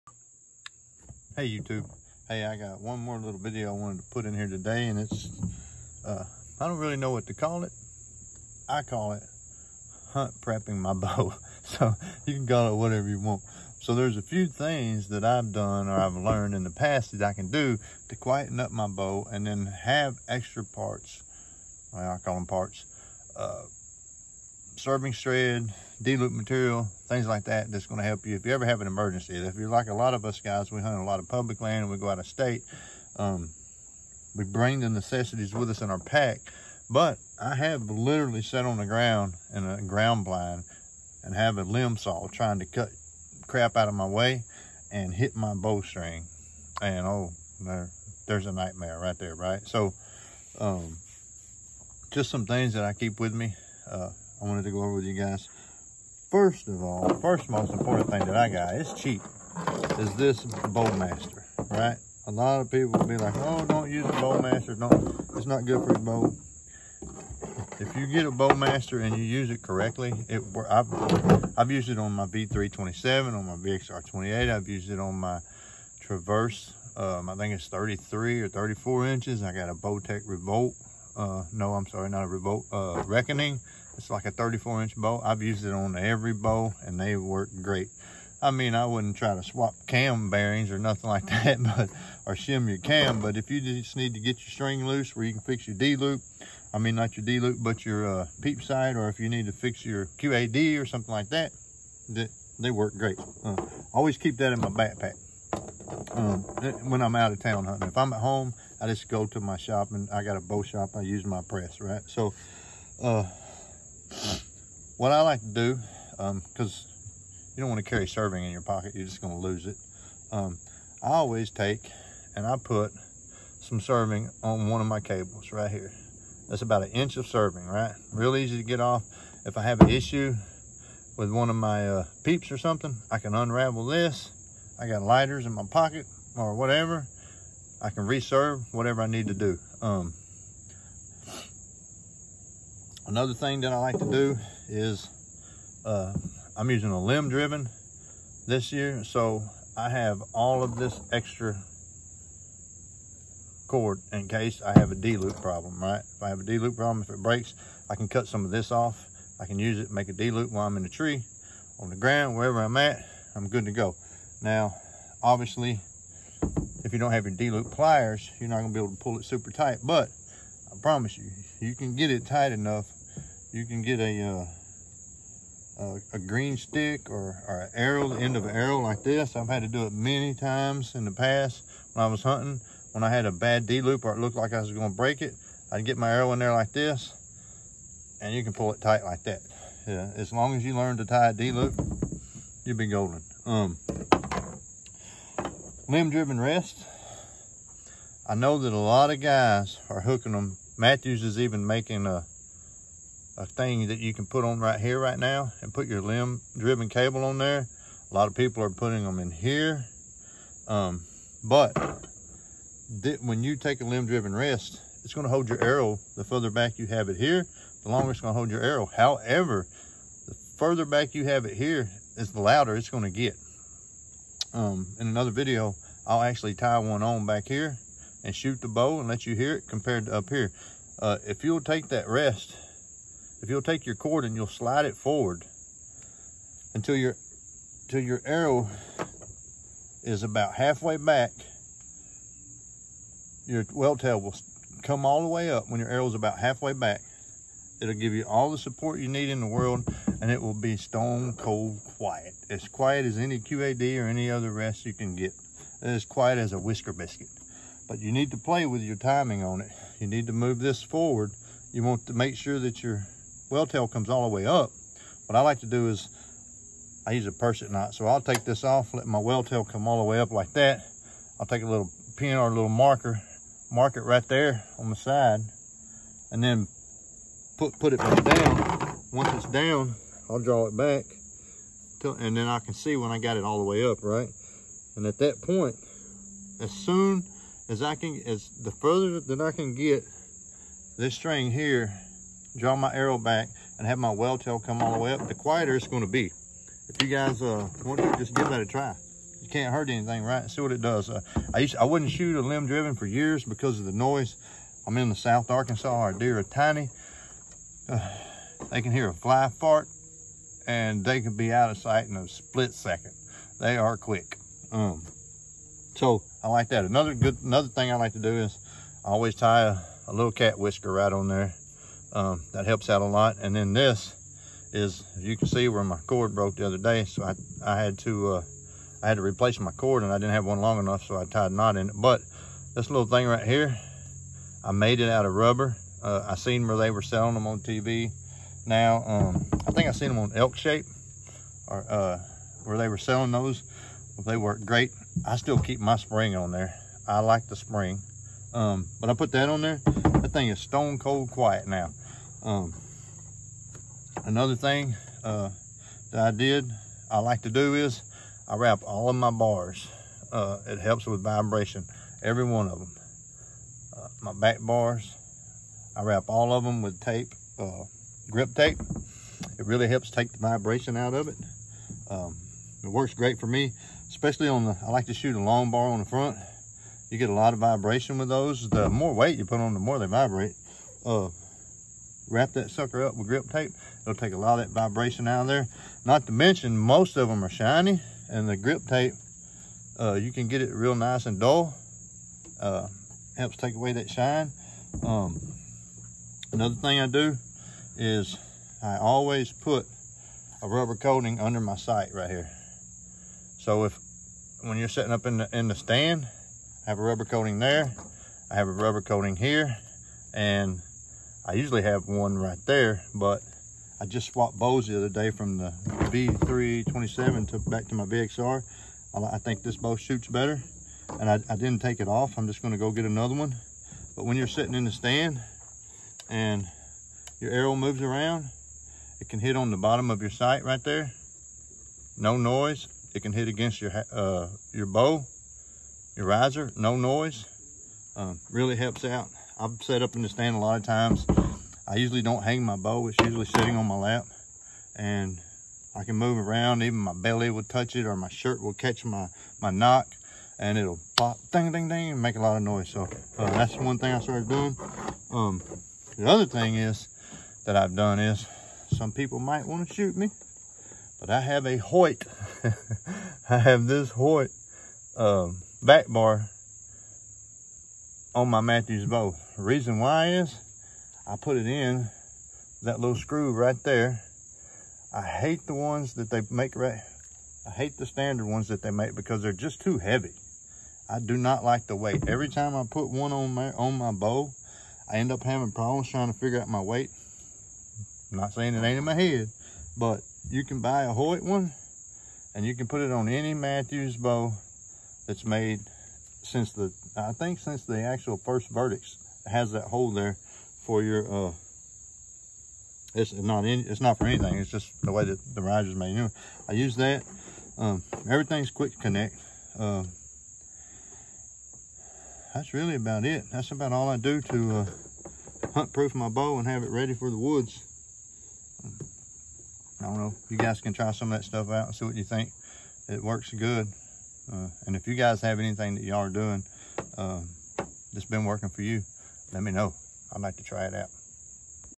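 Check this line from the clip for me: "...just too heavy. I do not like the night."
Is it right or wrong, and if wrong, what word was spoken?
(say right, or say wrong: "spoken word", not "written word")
wrong: "weight", not "night".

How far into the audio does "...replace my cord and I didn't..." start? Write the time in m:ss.
5:29.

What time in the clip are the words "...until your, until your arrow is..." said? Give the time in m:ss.
3:56.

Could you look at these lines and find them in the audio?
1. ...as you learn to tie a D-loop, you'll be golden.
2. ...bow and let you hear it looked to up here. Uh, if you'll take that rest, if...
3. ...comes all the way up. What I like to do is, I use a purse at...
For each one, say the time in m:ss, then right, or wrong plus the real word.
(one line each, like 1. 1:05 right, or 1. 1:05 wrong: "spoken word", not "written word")
1. 3:10 right
2. 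3:48 wrong: "compared", not "looked"
3. 4:23 right.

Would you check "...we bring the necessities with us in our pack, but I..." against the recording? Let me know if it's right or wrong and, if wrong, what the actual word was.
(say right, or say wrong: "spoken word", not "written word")
right.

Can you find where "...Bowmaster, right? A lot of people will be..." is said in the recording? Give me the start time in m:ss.
1:00.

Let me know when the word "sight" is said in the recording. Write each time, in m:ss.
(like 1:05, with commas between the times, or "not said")
5:11, 6:41, 7:10.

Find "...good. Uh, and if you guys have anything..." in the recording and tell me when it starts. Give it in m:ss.
8:43.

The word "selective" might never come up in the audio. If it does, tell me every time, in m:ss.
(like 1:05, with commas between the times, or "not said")
not said.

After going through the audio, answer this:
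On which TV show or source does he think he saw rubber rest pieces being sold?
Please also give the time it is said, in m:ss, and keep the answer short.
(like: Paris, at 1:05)
Elk Shape, at 5:40.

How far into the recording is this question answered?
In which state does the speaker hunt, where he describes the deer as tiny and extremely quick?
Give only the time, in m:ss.
5:05.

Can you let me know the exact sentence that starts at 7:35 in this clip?
Um, the other thing is that I've done is some people might want to shoot me.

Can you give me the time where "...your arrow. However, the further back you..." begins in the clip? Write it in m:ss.
3:38.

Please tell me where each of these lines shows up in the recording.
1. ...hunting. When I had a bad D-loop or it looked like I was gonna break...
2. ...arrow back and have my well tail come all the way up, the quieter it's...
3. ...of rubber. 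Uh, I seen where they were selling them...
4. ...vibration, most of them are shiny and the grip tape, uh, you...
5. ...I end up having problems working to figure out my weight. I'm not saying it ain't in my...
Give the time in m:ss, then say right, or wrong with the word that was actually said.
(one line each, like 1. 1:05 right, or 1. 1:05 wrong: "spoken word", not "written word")
1. 3:02 right
2. 4:52 right
3. 5:35 right
4. 6:26 wrong: "mention", not "vibration"
5. 8:05 wrong: "trying", not "working".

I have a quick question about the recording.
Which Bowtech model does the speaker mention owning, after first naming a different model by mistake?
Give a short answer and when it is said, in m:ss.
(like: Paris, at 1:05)
Reckoning, at 1:23.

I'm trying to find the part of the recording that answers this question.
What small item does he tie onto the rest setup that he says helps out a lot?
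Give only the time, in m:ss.
5:20.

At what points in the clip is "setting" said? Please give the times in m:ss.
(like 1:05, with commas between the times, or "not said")
6:44.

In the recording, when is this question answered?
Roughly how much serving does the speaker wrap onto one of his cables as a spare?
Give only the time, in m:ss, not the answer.
2:06.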